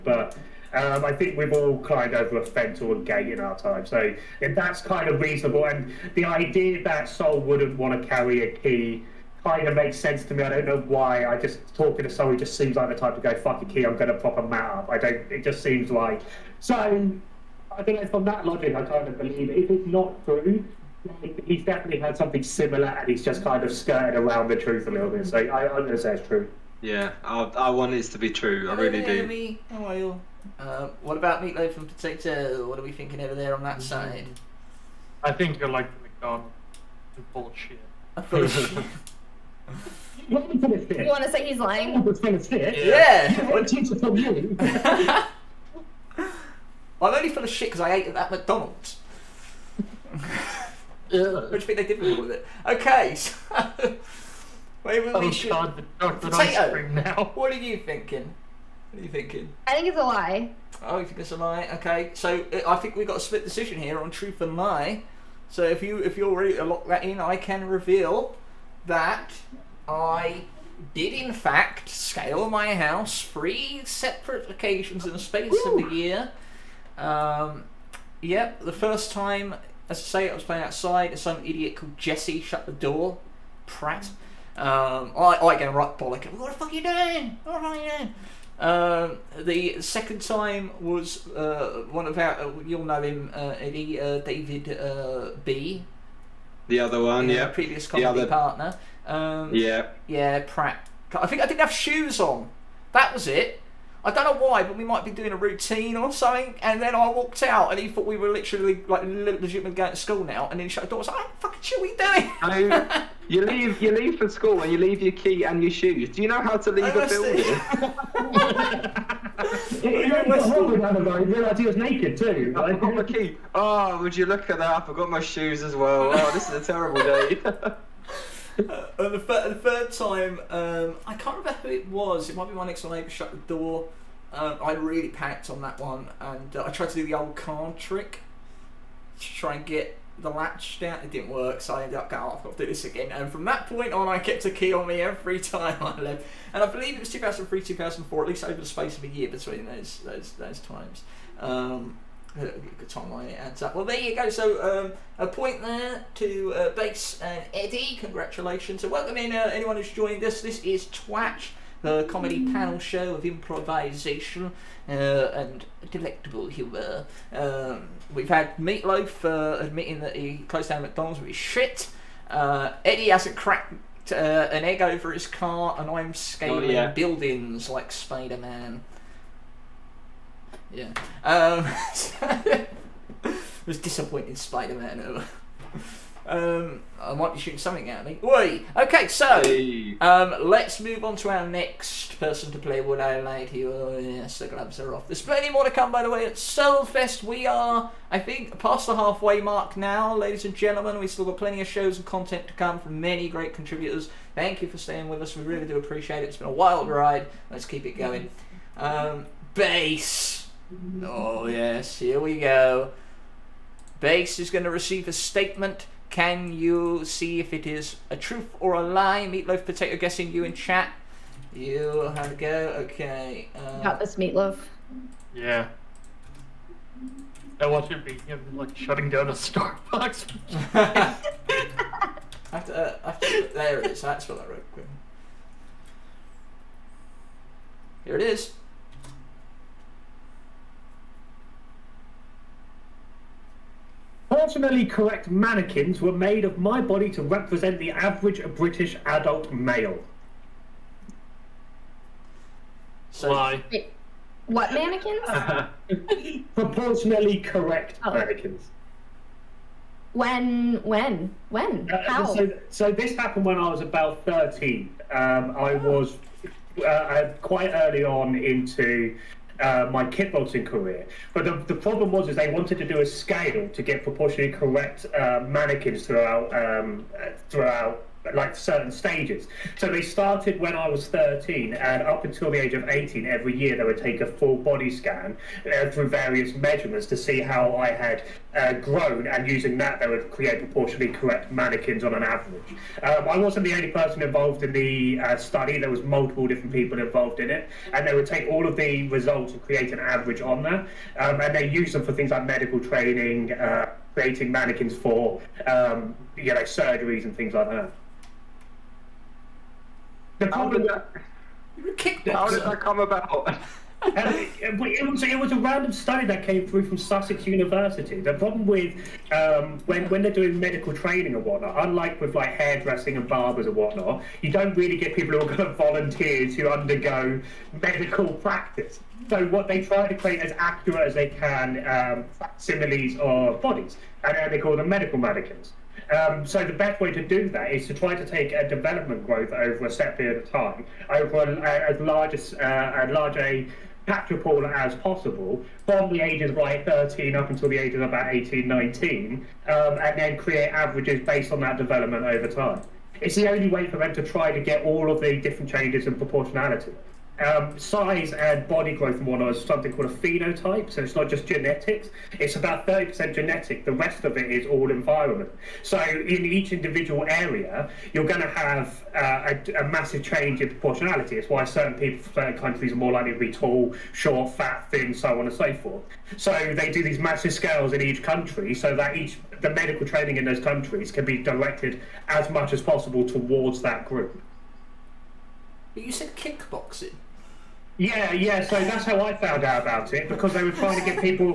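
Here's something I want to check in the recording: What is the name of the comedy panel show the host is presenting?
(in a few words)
Twatch.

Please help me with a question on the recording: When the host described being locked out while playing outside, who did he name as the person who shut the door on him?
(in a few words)
Jesse.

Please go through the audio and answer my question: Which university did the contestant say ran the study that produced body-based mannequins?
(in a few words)
Sussex University.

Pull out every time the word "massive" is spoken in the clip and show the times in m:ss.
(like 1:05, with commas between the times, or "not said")
6:09, 6:17.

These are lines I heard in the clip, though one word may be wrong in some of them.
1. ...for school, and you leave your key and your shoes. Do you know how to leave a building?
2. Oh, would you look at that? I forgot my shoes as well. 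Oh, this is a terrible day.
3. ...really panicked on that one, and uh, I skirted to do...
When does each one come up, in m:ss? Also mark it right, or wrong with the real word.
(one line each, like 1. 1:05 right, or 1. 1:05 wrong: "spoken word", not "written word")
1. 1:54 right
2. 2:03 right
3. 2:14 wrong: "tried", not "skirted".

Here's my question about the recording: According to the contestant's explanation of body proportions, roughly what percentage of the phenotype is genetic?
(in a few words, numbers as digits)
30%.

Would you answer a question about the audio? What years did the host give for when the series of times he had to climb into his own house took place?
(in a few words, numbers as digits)
2003, 2004.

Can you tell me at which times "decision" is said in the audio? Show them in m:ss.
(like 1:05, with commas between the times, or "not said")
1:03.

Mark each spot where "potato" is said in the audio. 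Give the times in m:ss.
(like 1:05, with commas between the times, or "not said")
0:31, 0:56, 3:39.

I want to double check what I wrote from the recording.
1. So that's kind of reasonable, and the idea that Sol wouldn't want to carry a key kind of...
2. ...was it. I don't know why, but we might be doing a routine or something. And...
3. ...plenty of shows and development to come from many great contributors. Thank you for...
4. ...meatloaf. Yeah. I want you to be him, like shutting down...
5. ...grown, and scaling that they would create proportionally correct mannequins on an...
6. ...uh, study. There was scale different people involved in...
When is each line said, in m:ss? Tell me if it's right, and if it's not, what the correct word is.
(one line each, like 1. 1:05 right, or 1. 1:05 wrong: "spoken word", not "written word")
1. 0:03 right
2. 1:43 right
3. 3:21 wrong: "content", not "development"
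4. 3:44 right
5. 4:48 wrong: "using", not "scaling"
6. 4:55 wrong: "multiple", not "scale".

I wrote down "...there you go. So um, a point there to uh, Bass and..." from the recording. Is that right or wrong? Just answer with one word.
right.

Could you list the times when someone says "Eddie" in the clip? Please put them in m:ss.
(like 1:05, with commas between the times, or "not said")
1:33, 2:37, 2:52.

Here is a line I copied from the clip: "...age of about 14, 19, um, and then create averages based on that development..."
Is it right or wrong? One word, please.
wrong.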